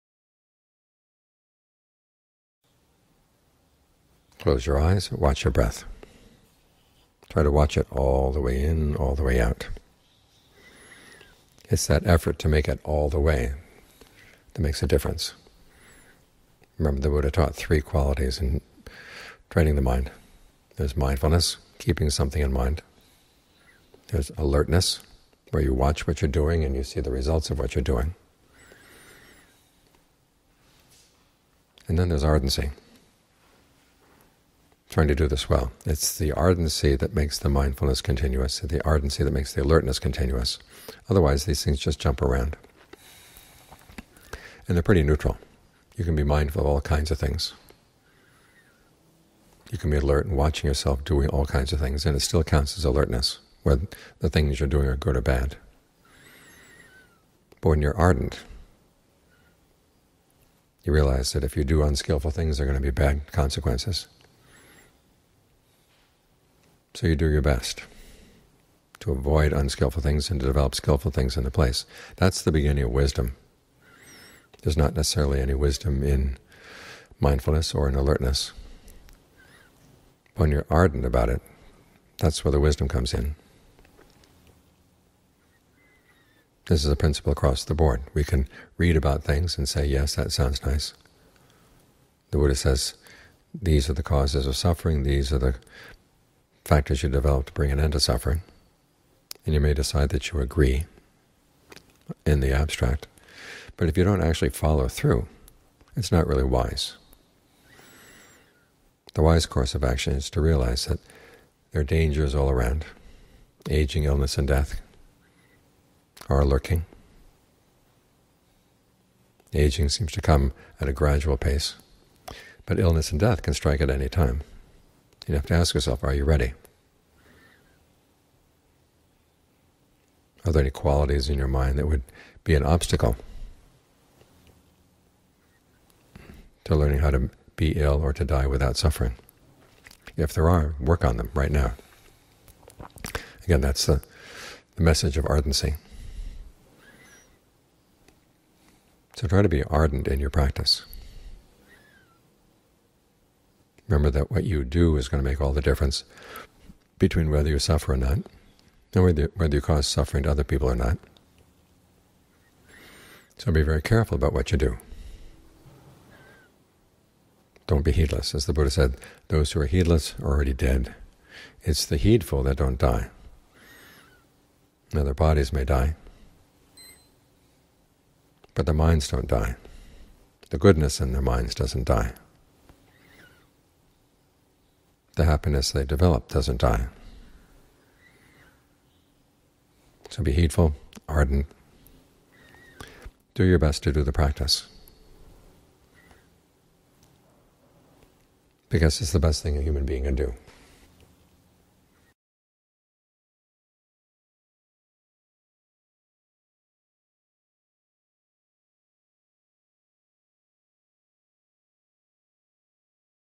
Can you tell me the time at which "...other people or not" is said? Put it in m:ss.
2:40.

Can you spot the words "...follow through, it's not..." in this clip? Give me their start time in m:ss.
1:44.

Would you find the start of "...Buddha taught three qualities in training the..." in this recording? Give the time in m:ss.
0:17.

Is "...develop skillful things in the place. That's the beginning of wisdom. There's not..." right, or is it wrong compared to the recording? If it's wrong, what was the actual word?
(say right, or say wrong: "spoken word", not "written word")
right.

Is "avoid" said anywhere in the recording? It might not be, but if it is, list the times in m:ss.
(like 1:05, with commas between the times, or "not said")
1:09.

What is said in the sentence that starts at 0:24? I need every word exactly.
There's alertness, where you watch what you're doing and you see the results of what you're doing.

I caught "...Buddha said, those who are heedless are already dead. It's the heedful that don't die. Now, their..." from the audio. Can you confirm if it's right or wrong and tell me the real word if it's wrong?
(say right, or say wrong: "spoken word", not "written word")
right.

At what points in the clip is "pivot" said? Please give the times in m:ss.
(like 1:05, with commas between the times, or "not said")
not said.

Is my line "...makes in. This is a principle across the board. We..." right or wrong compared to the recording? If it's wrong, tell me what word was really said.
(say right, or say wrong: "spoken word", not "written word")
wrong: "comes", not "makes".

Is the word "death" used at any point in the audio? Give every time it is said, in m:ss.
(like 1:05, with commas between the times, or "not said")
1:54, 2:03.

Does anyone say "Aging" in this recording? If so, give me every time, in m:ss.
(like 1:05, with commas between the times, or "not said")
1:53, 1:59.